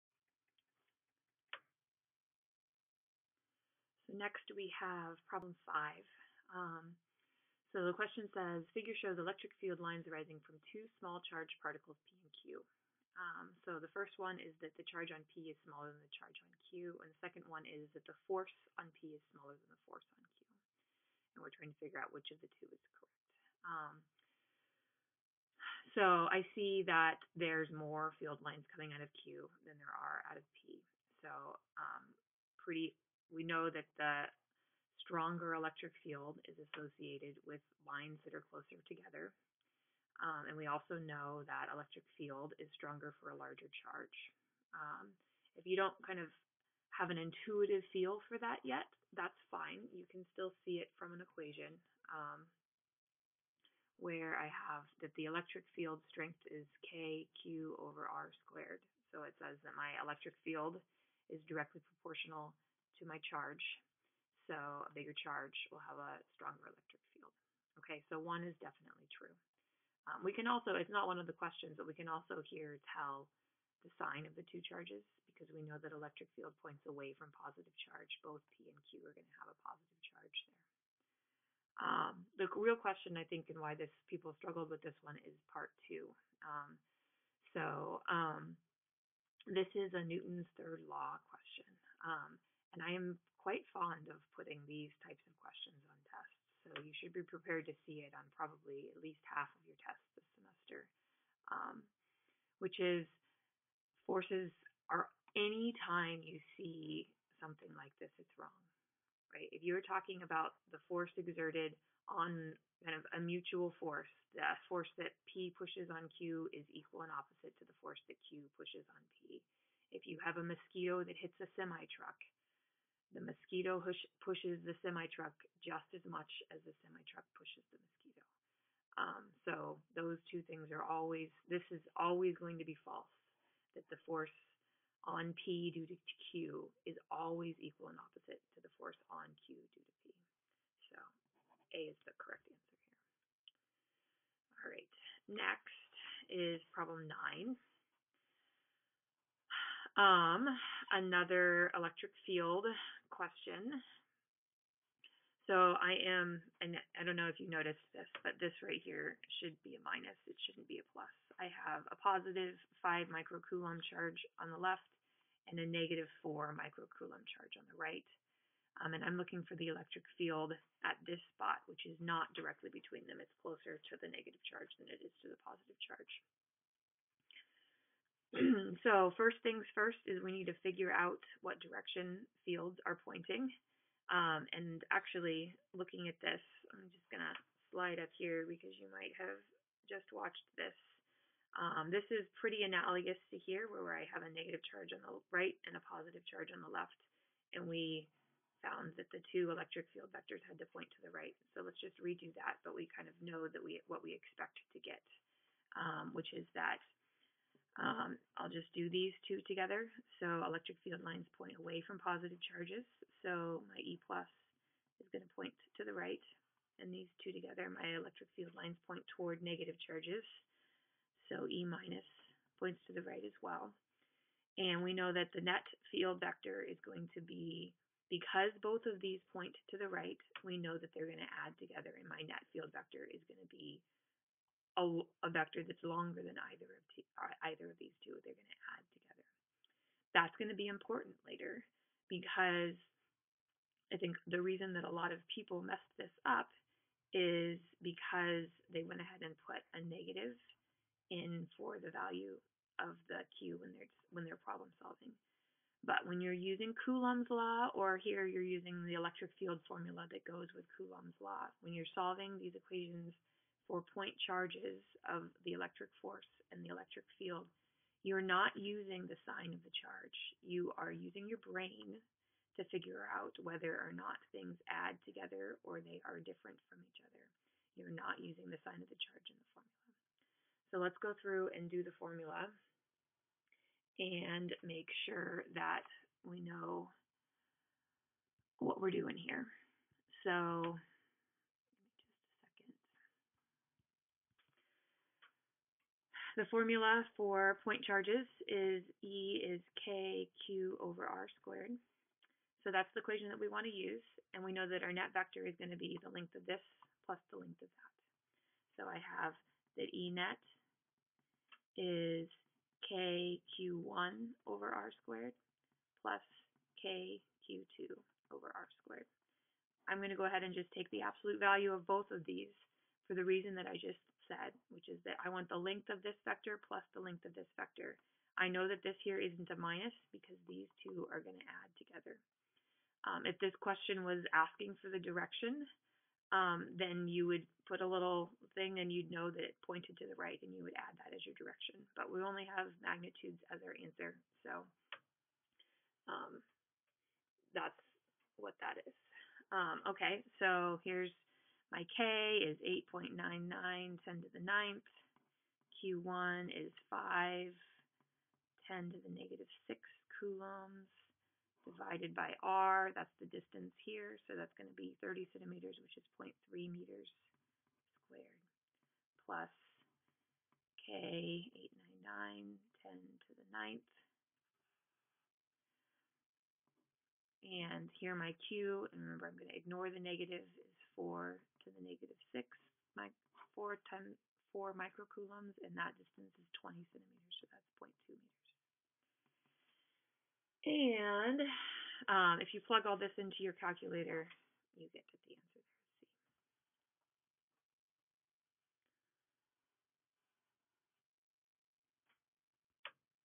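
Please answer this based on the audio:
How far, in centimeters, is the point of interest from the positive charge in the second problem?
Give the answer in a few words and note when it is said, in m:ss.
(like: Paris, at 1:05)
30 centimeters, at 6:05.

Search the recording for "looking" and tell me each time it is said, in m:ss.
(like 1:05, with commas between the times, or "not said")
2:49, 3:05.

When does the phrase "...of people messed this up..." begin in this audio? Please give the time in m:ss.
4:05.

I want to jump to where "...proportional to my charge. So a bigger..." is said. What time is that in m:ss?
1:01.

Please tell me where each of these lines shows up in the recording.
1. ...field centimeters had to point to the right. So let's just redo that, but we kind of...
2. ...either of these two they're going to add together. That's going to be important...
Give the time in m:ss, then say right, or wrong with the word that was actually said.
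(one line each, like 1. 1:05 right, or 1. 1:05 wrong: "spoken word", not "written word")
1. 3:19 wrong: "vectors", not "centimeters"
2. 3:57 right.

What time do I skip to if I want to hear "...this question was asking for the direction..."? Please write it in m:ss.
5:33.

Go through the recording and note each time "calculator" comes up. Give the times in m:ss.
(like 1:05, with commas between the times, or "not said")
6:33.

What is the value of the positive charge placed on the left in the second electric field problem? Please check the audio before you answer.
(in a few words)
5 microcoulombs.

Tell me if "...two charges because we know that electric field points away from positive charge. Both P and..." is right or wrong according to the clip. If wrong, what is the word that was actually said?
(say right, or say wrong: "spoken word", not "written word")
right.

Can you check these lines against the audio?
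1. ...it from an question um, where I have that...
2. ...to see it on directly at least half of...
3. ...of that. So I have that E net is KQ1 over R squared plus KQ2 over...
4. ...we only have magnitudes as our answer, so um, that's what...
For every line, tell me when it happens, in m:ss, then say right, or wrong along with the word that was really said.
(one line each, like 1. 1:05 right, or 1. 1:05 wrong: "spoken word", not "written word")
1. 0:50 wrong: "equation", not "question"
2. 1:37 wrong: "probably", not "directly"
3. 5:07 right
4. 5:42 right.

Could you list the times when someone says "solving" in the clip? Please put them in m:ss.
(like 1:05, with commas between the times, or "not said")
4:14, 4:21.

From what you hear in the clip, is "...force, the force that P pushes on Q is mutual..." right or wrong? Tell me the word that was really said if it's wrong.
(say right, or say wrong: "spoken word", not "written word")
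wrong: "equal", not "mutual".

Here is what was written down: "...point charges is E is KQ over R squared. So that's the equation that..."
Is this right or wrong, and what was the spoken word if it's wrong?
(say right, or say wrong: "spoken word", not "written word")
right.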